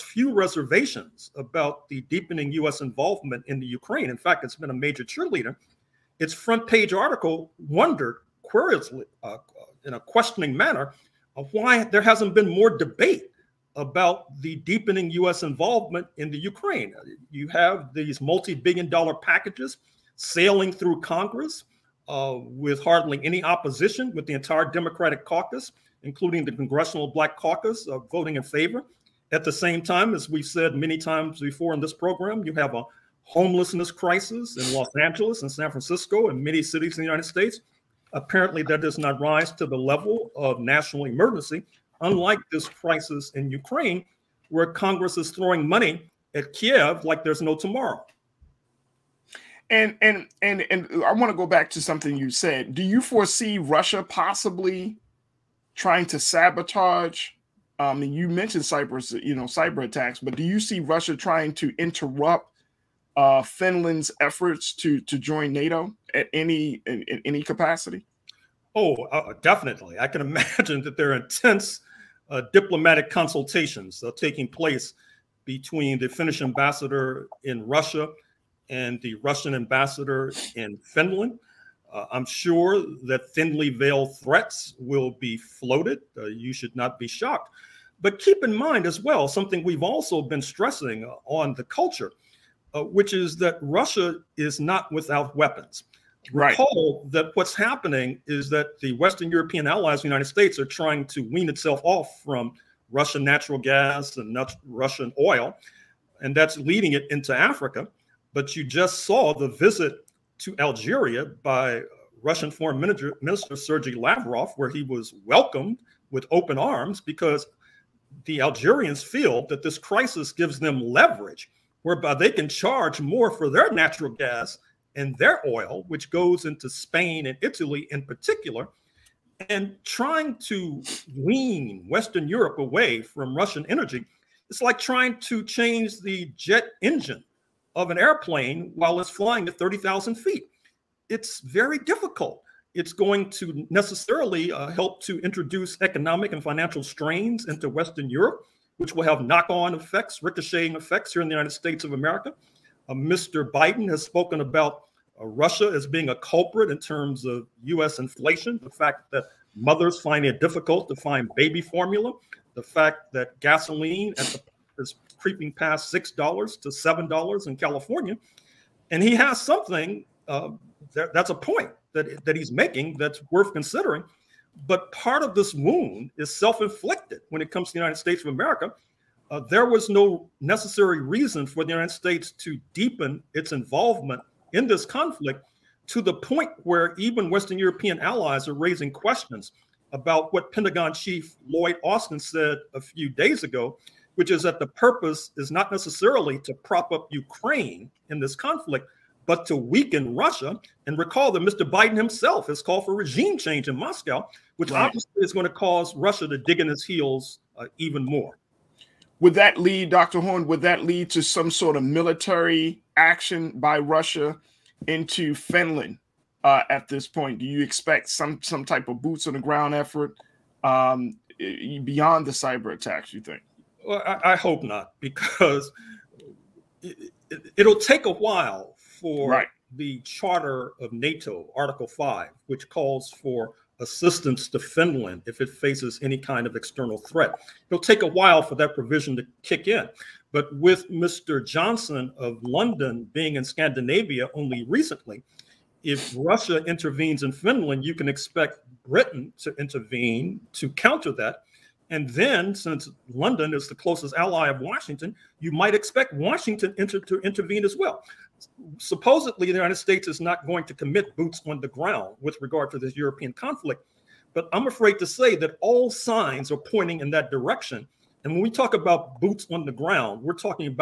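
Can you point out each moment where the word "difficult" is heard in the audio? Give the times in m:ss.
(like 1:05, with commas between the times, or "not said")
2:21, 2:40.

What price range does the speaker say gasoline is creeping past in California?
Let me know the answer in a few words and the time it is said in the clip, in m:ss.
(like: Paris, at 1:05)
$6 to $7, at 2:45.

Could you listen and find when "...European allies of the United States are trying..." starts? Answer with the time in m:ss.
1:39.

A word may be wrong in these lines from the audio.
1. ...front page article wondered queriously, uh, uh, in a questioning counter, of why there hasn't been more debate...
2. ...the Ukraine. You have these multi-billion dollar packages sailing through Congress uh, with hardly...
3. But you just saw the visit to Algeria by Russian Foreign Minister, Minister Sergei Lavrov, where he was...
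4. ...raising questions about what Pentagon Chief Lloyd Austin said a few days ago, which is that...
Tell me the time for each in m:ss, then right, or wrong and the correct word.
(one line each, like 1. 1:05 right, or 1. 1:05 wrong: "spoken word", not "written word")
1. 0:06 wrong: "manner", not "counter"
2. 0:16 right
3. 1:48 right
4. 3:08 right.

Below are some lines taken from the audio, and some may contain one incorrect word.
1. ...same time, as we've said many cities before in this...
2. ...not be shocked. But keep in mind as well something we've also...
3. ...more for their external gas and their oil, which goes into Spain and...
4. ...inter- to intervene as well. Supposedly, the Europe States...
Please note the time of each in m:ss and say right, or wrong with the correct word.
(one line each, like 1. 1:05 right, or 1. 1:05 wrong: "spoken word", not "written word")
1. 0:29 wrong: "times", not "cities"
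2. 1:26 right
3. 2:03 wrong: "natural", not "external"
4. 4:16 wrong: "United", not "Europe".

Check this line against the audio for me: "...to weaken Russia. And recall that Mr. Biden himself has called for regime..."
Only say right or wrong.
right.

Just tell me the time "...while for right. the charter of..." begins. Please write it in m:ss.
3:48.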